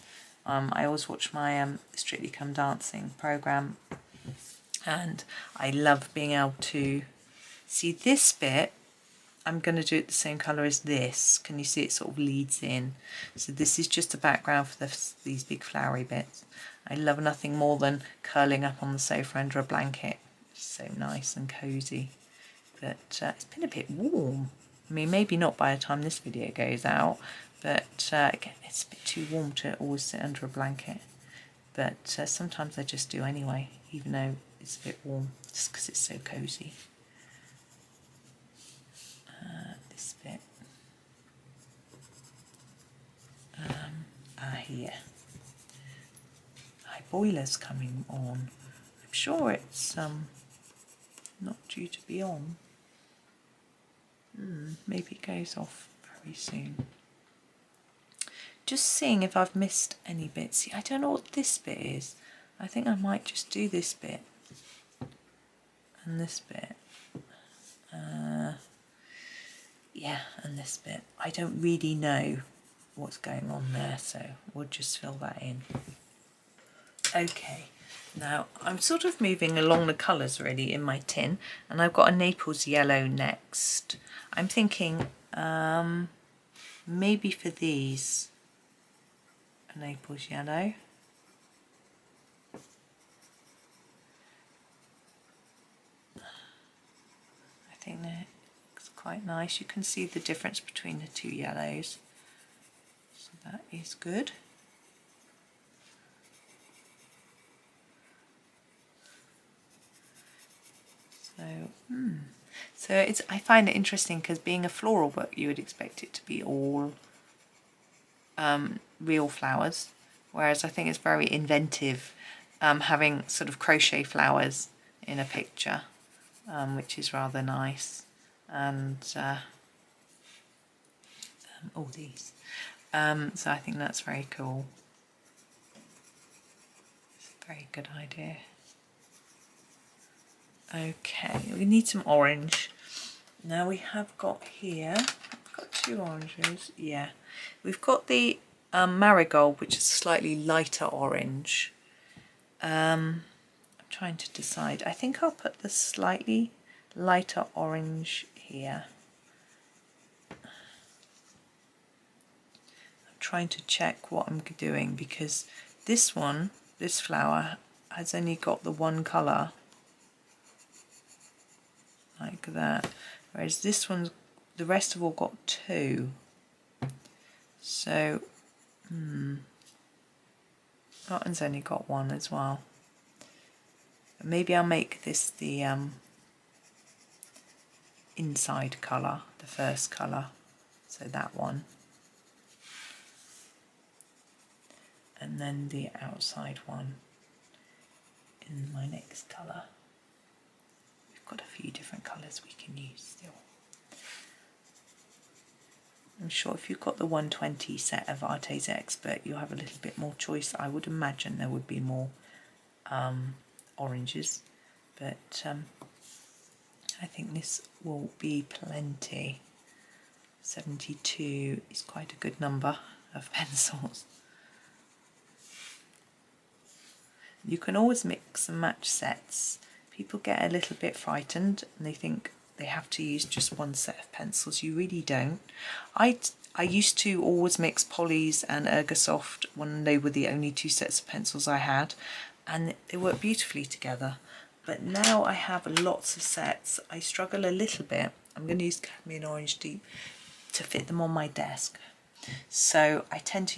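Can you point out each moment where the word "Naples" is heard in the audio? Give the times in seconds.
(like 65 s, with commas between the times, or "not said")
82 s, 89 s.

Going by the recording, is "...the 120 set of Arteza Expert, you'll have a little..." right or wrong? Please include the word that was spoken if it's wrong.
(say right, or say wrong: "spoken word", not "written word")
right.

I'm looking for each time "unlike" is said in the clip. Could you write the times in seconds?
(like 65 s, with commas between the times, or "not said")
not said.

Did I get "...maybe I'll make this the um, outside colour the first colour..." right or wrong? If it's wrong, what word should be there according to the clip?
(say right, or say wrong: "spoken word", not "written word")
wrong: "inside", not "outside".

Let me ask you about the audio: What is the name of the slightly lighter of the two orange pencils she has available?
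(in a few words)
marigold.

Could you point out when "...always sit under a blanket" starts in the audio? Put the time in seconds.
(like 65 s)
29 s.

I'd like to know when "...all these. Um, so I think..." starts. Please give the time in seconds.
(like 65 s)
131 s.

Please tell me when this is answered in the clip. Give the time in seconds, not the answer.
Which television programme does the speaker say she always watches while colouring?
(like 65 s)
1 s.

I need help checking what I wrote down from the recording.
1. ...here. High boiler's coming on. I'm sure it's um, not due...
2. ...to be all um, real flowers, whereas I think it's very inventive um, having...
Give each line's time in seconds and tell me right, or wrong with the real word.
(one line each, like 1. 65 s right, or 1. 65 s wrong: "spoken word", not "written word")
1. 44 s right
2. 116 s right.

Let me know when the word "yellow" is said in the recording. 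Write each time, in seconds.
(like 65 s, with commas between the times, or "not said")
82 s, 90 s, 101 s.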